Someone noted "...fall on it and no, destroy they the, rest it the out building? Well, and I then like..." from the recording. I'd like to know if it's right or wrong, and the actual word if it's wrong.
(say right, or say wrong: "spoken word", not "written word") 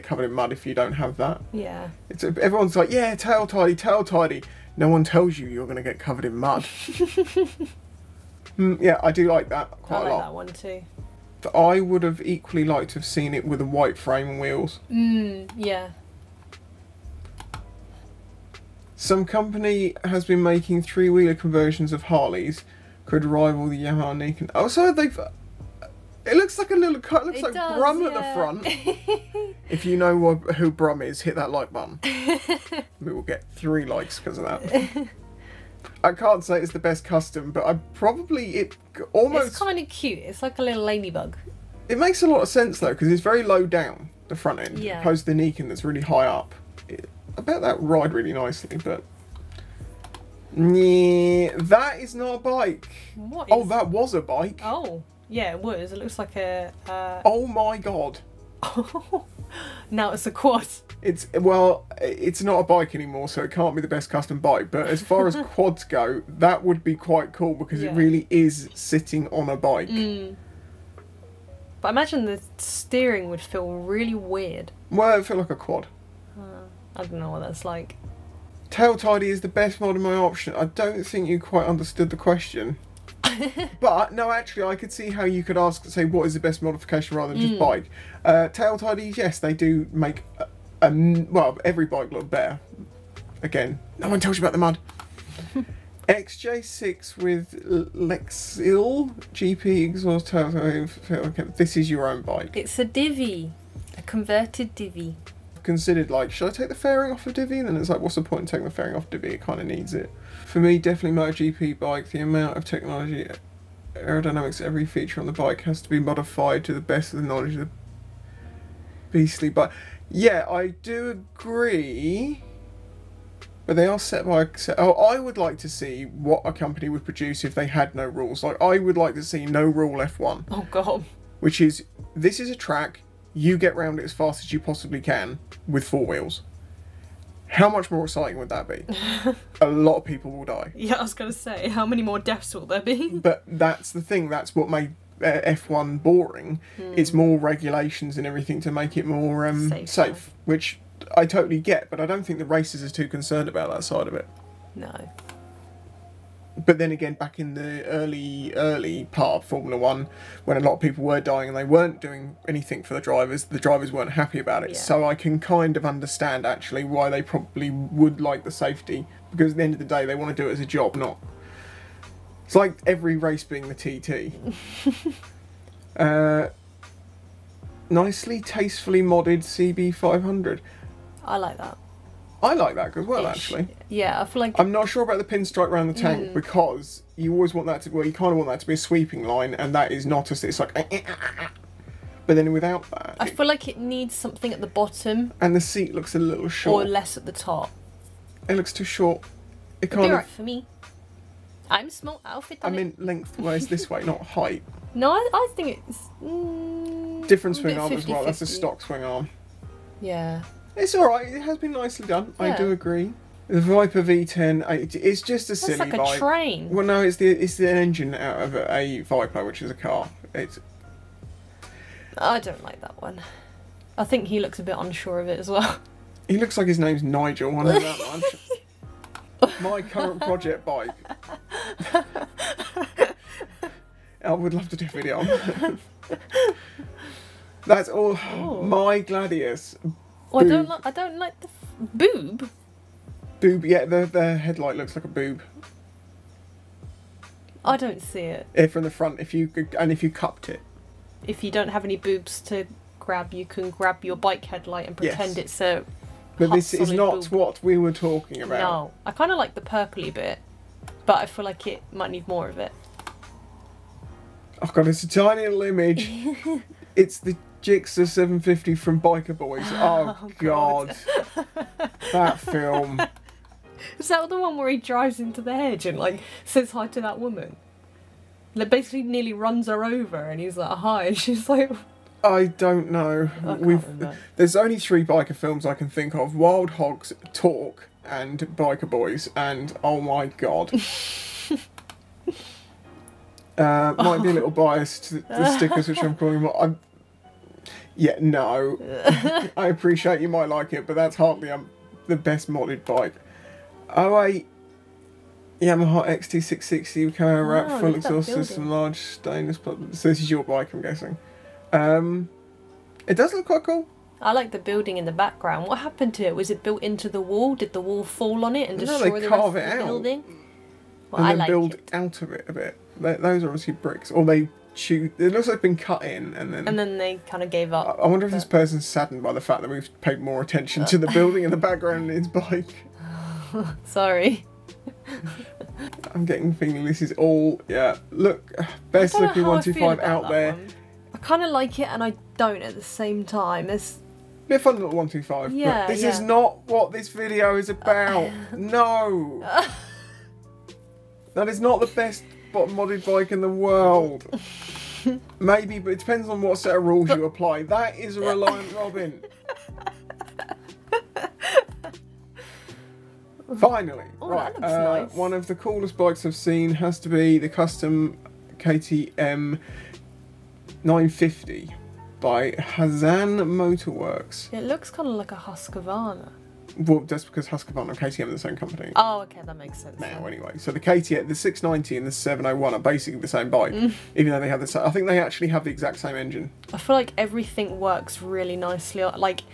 right.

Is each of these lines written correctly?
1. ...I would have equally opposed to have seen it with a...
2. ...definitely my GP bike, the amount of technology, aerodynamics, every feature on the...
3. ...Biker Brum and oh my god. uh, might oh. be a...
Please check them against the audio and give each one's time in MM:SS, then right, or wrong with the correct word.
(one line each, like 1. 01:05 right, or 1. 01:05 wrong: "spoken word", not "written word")
1. 00:11 wrong: "liked", not "opposed"
2. 01:50 right
3. 04:48 wrong: "Boys", not "Brum".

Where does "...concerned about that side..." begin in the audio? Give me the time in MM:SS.
02:33.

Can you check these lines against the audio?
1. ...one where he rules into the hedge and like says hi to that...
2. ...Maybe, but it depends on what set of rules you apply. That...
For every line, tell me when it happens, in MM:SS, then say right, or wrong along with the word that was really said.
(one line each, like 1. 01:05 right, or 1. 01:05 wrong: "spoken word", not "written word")
1. 04:34 wrong: "drives", not "rules"
2. 05:55 right.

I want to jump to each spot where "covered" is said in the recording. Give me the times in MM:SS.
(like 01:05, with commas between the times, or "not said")
00:00, 00:05.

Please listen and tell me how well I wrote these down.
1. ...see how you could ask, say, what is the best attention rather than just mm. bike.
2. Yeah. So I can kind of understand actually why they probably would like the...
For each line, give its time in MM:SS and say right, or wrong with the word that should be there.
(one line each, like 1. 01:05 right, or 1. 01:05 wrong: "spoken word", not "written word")
1. 01:24 wrong: "modification", not "attention"
2. 02:44 right.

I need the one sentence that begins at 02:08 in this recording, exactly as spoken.
Like, I would like to see no rule F1.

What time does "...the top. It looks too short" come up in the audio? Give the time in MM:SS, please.
03:17.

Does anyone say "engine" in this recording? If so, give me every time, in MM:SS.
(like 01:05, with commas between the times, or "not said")
03:37, 06:26.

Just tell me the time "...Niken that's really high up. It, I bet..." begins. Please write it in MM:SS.
00:45.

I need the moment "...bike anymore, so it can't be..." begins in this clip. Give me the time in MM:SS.
01:02.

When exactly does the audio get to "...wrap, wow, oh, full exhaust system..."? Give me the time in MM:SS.
05:07.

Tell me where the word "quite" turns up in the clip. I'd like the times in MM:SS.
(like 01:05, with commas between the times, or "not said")
00:09, 01:06, 01:21, 05:13.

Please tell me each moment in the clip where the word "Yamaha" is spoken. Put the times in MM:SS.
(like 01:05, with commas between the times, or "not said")
00:23, 05:05.